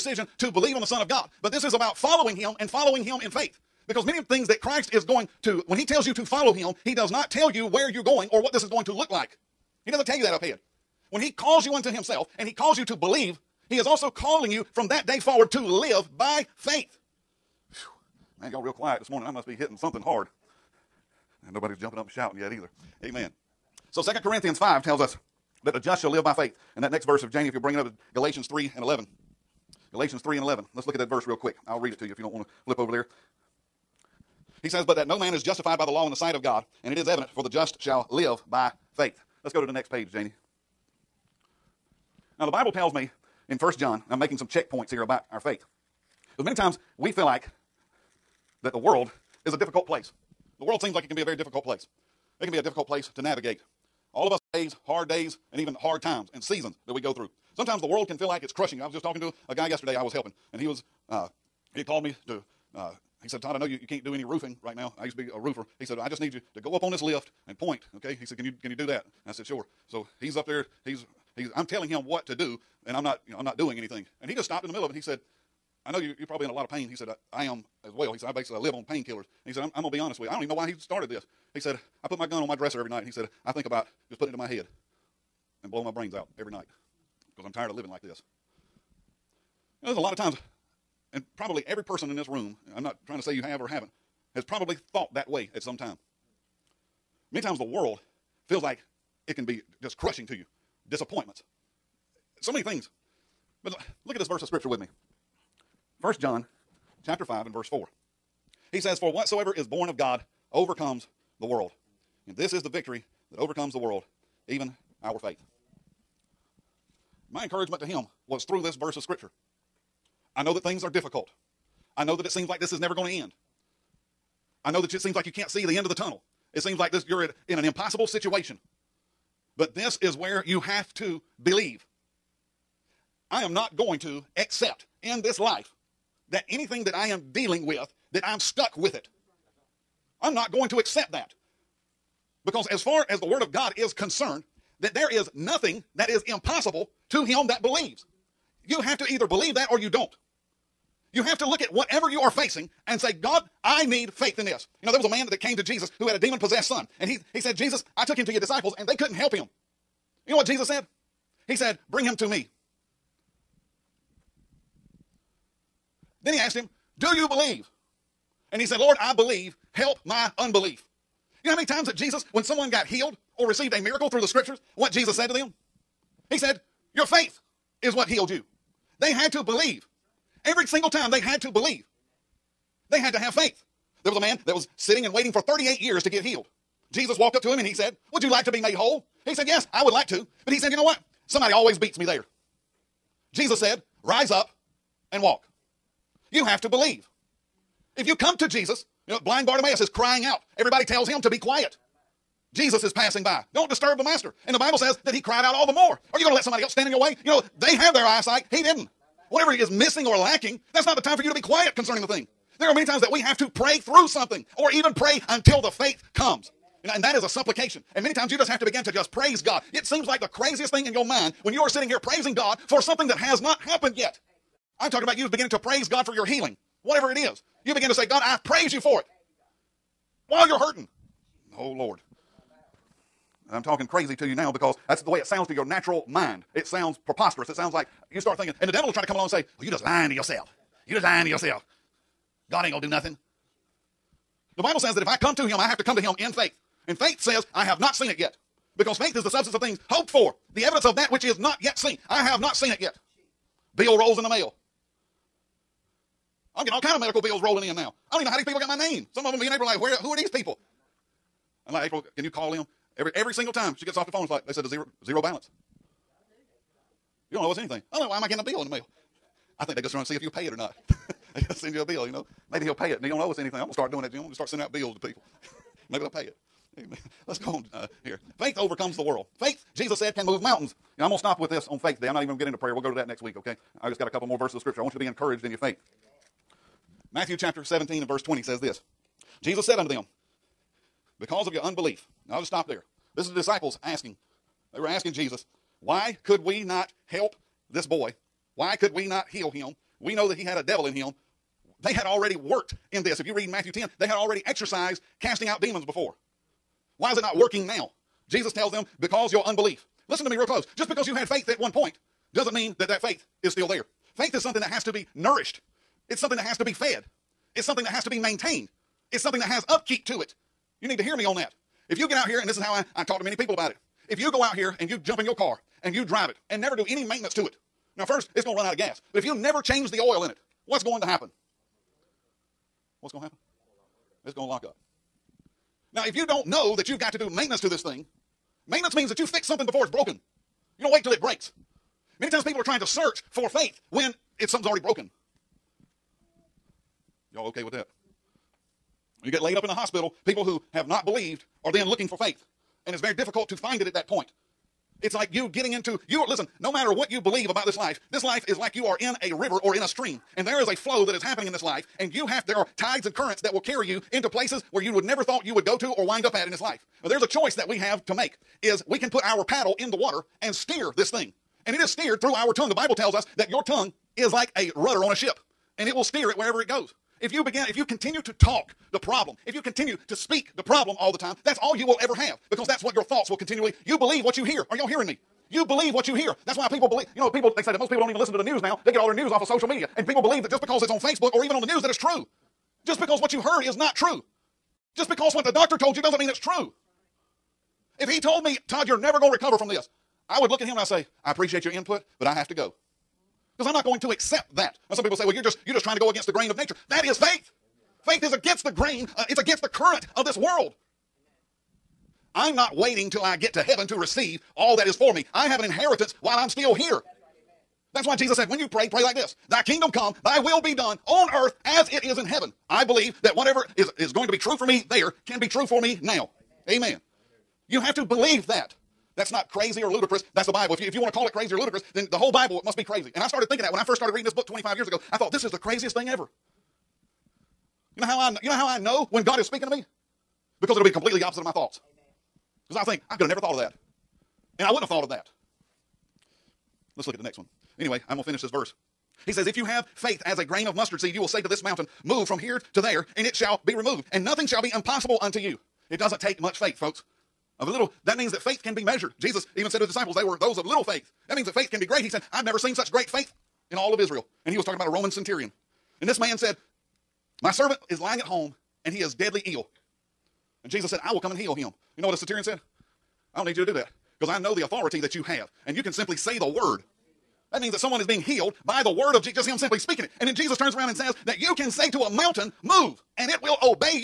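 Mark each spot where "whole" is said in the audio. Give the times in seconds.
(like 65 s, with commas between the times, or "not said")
188 s, 432 s.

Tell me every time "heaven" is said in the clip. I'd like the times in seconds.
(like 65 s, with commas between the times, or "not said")
413 s, 422 s.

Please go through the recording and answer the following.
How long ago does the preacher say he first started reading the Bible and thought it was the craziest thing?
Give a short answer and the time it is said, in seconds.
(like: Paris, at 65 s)
25 years ago, at 434 s.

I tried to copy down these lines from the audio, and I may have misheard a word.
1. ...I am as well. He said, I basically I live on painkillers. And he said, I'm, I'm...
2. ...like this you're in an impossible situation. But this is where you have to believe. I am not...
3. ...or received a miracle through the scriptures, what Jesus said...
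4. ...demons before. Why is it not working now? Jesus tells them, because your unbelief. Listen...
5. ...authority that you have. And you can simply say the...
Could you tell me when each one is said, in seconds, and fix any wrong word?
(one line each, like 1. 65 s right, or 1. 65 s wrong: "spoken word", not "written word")
1. 77 s right
2. 126 s right
3. 173 s right
4. 305 s right
5. 474 s right.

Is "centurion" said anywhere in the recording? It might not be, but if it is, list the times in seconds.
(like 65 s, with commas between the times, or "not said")
465 s, 472 s.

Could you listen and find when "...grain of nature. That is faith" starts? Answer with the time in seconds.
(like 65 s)
406 s.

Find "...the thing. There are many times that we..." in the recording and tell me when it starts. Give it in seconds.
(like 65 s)
212 s.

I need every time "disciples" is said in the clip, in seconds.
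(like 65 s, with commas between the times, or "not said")
158 s, 293 s, 459 s.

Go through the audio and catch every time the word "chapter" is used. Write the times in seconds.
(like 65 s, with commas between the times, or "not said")
107 s, 287 s.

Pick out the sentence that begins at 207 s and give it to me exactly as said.
You know, they have their eyesight.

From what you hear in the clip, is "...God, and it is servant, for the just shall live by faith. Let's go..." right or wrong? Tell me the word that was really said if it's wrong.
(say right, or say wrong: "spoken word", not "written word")
wrong: "evident", not "servant".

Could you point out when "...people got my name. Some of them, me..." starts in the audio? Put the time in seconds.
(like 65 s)
258 s.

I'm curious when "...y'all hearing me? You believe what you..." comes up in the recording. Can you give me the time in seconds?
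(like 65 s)
384 s.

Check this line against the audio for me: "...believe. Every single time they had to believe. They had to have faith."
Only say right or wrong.
right.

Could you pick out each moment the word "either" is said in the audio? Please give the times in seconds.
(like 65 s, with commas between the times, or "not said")
22 s, 149 s.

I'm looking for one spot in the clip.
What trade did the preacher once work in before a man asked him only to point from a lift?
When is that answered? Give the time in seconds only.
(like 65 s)
65 s.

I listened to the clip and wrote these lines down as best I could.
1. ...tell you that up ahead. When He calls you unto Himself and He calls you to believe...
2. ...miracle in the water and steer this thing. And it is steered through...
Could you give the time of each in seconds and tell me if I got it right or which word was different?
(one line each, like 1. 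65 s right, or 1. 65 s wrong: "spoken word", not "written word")
1. 10 s right
2. 369 s wrong: "paddle", not "miracle".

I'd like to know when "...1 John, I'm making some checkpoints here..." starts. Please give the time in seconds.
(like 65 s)
43 s.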